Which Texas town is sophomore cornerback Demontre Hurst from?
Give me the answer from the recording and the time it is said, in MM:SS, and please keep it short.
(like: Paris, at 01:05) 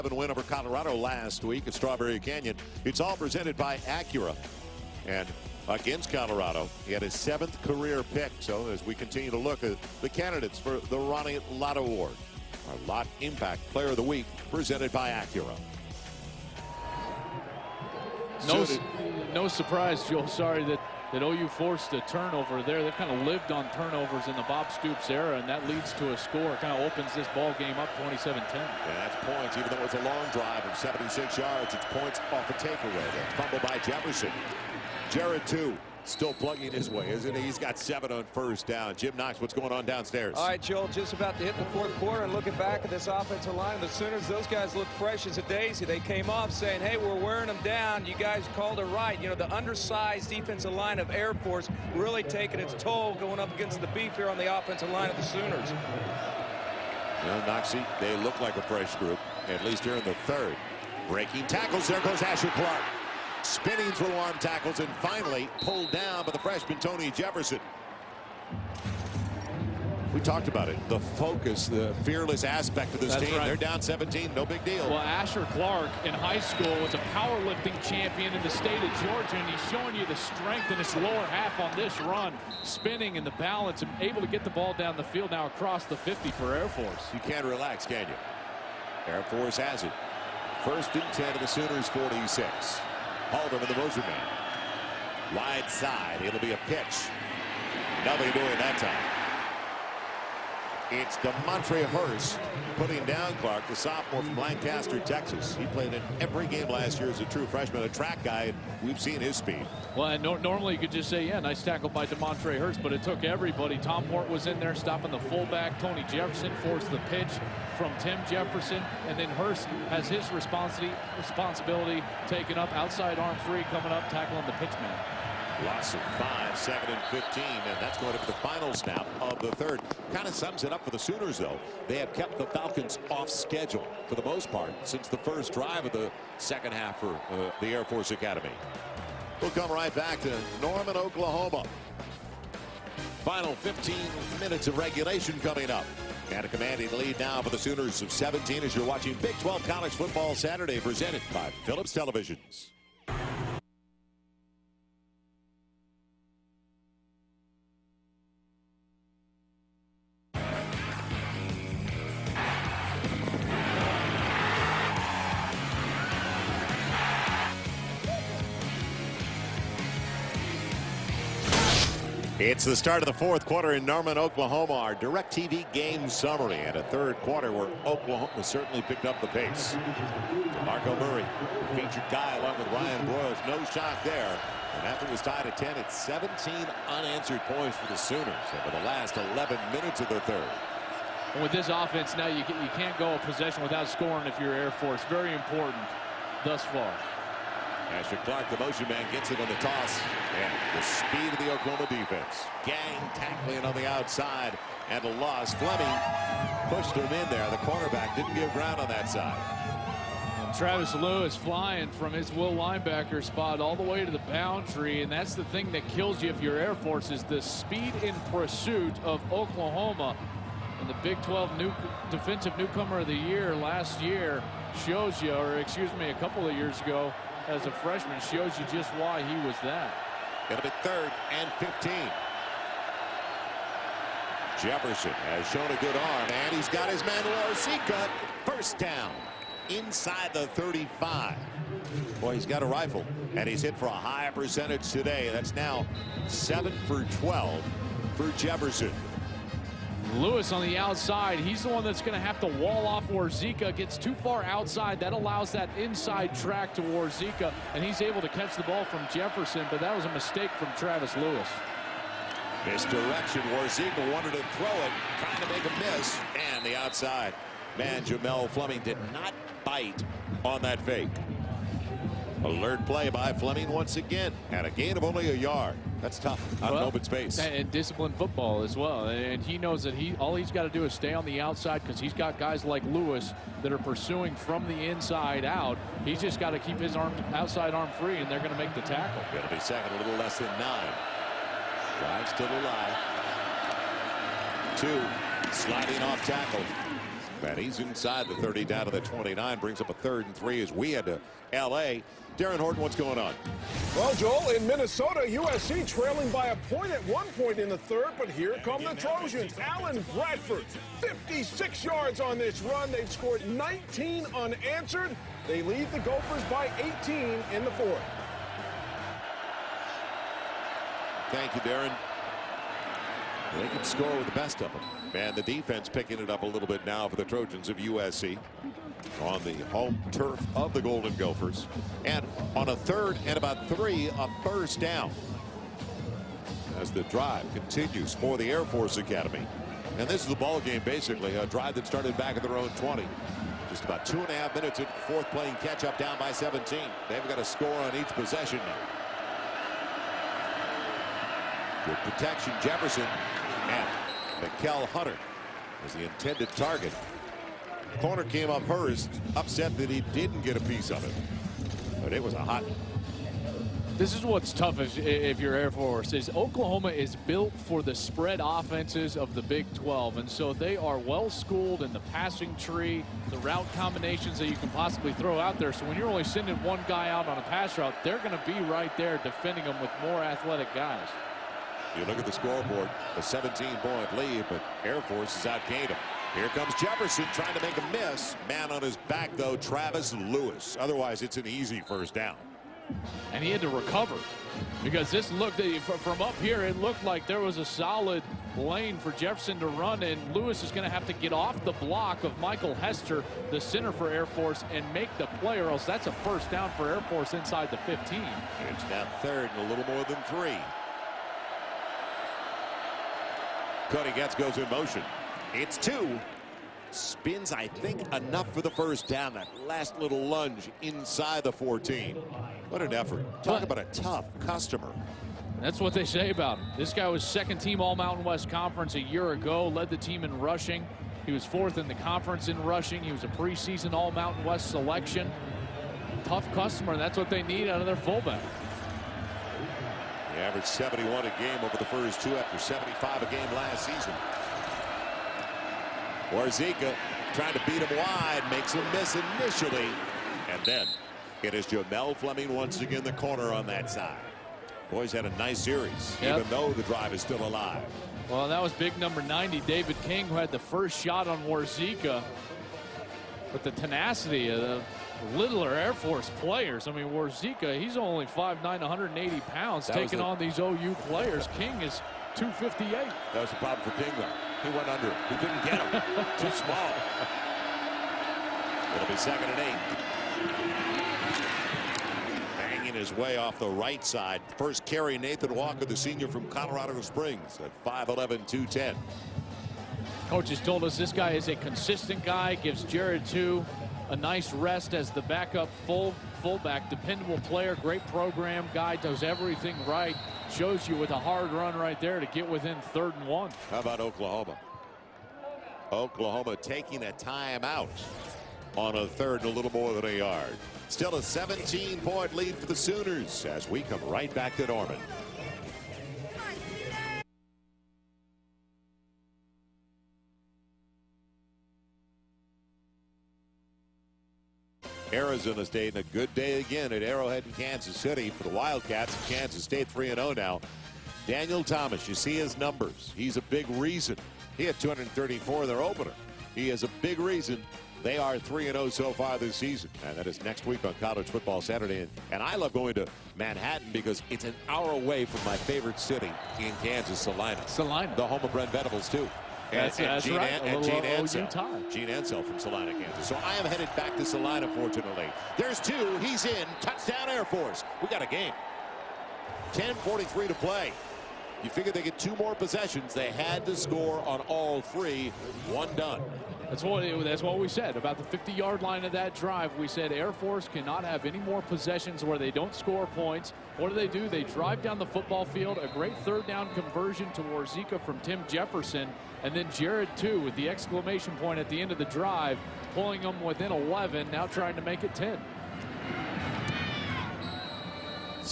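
Lancaster, at 01:44.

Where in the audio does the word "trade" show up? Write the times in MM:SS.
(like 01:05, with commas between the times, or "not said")
not said.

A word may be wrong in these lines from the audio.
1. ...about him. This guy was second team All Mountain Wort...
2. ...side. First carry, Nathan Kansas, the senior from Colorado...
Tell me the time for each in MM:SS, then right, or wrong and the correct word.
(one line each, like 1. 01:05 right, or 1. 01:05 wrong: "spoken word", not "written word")
1. 07:06 wrong: "West", not "Wort"
2. 08:04 wrong: "Walker", not "Kansas".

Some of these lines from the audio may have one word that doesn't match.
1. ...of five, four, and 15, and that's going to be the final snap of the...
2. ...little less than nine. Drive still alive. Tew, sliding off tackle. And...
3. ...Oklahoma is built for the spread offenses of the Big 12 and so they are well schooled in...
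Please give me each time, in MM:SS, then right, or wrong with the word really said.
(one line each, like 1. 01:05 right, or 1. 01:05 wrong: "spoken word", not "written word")
1. 02:05 wrong: "seven", not "four"
2. 04:49 right
3. 06:06 right.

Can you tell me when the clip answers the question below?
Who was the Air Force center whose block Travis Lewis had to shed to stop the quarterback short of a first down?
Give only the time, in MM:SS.
06:42.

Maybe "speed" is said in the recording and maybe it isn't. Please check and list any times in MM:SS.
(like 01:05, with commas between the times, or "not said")
01:49, 03:20, 03:37.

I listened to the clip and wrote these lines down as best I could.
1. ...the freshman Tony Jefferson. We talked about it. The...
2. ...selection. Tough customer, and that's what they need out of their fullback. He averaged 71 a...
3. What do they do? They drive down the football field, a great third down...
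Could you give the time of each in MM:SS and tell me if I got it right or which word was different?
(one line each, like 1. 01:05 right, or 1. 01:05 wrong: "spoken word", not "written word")
1. 01:06 right
2. 07:14 right
3. 09:33 right.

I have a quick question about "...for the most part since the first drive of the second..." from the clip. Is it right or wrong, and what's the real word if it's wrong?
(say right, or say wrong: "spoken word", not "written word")
right.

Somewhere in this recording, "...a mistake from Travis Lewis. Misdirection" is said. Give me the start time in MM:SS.
04:20.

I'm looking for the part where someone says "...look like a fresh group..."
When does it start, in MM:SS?
00:58.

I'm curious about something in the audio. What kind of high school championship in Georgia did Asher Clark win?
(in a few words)
powerlifting.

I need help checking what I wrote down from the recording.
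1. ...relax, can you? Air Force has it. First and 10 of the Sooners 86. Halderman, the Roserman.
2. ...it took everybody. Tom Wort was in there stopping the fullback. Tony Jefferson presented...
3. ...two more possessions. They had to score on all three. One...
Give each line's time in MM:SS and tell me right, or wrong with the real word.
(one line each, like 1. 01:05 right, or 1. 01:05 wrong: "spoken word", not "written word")
1. 01:27 wrong: "46", not "86"
2. 01:52 wrong: "forced", not "presented"
3. 09:22 right.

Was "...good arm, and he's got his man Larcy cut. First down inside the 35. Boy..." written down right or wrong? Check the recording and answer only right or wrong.
right.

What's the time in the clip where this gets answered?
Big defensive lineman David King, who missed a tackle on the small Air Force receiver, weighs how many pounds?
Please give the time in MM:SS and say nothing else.
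07:52.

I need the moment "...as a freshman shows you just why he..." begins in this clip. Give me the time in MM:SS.
03:47.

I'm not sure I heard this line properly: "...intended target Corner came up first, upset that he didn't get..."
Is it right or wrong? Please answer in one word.
right.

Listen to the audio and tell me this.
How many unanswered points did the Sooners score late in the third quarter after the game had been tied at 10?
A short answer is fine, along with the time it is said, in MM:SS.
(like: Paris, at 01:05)
17, at 03:06.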